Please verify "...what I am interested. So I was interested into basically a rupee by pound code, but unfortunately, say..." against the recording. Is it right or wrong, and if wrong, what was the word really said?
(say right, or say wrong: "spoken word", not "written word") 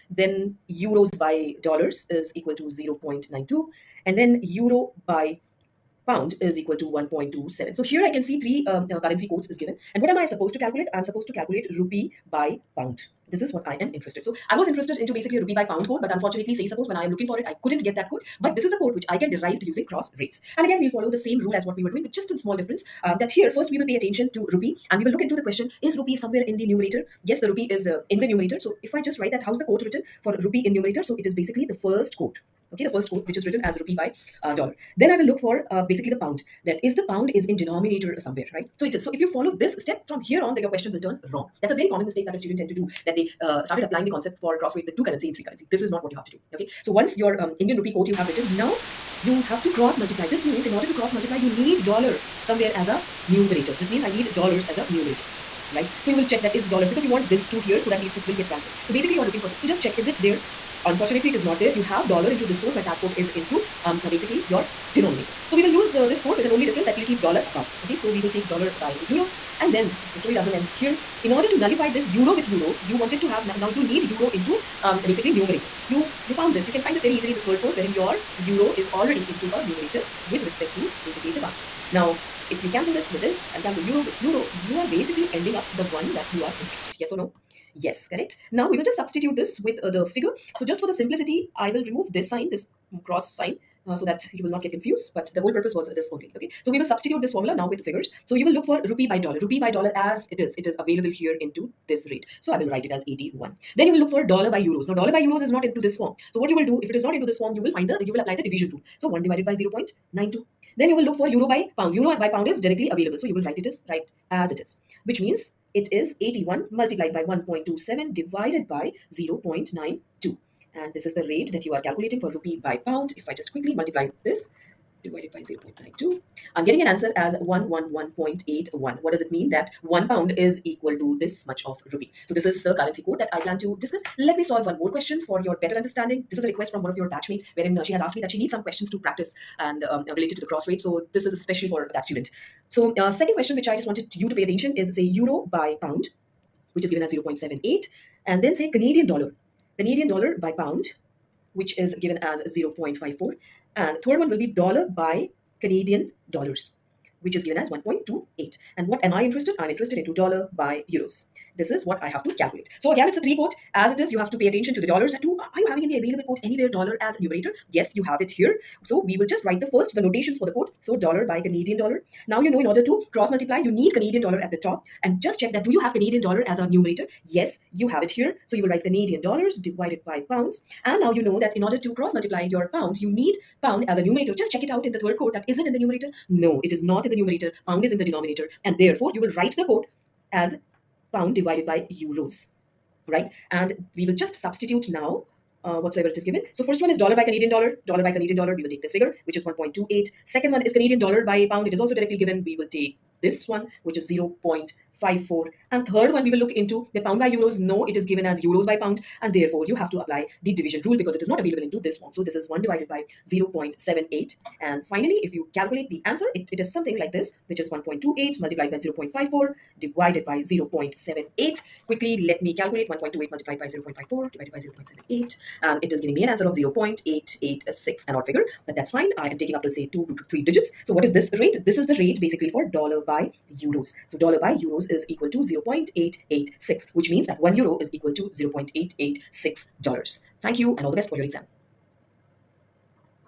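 right.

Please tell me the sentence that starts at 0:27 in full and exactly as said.
yes, the rupee is uh, in the numerator.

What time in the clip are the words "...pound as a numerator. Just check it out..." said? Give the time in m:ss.
3:03.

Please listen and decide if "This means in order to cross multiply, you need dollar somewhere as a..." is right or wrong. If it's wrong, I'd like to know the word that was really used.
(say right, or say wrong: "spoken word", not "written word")
right.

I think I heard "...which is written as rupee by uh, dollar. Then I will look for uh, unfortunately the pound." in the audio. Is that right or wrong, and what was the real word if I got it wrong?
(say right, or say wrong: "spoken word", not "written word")
wrong: "basically", not "unfortunately".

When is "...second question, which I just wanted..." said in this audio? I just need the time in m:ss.
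2:23.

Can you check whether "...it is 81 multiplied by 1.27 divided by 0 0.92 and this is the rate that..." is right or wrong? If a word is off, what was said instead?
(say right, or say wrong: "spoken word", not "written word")
right.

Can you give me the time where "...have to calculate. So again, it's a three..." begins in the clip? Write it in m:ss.
2:42.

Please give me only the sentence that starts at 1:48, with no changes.
So 1 divided by 0 0.92.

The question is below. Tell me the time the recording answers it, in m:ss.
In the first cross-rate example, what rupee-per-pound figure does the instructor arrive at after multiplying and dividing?
2:07.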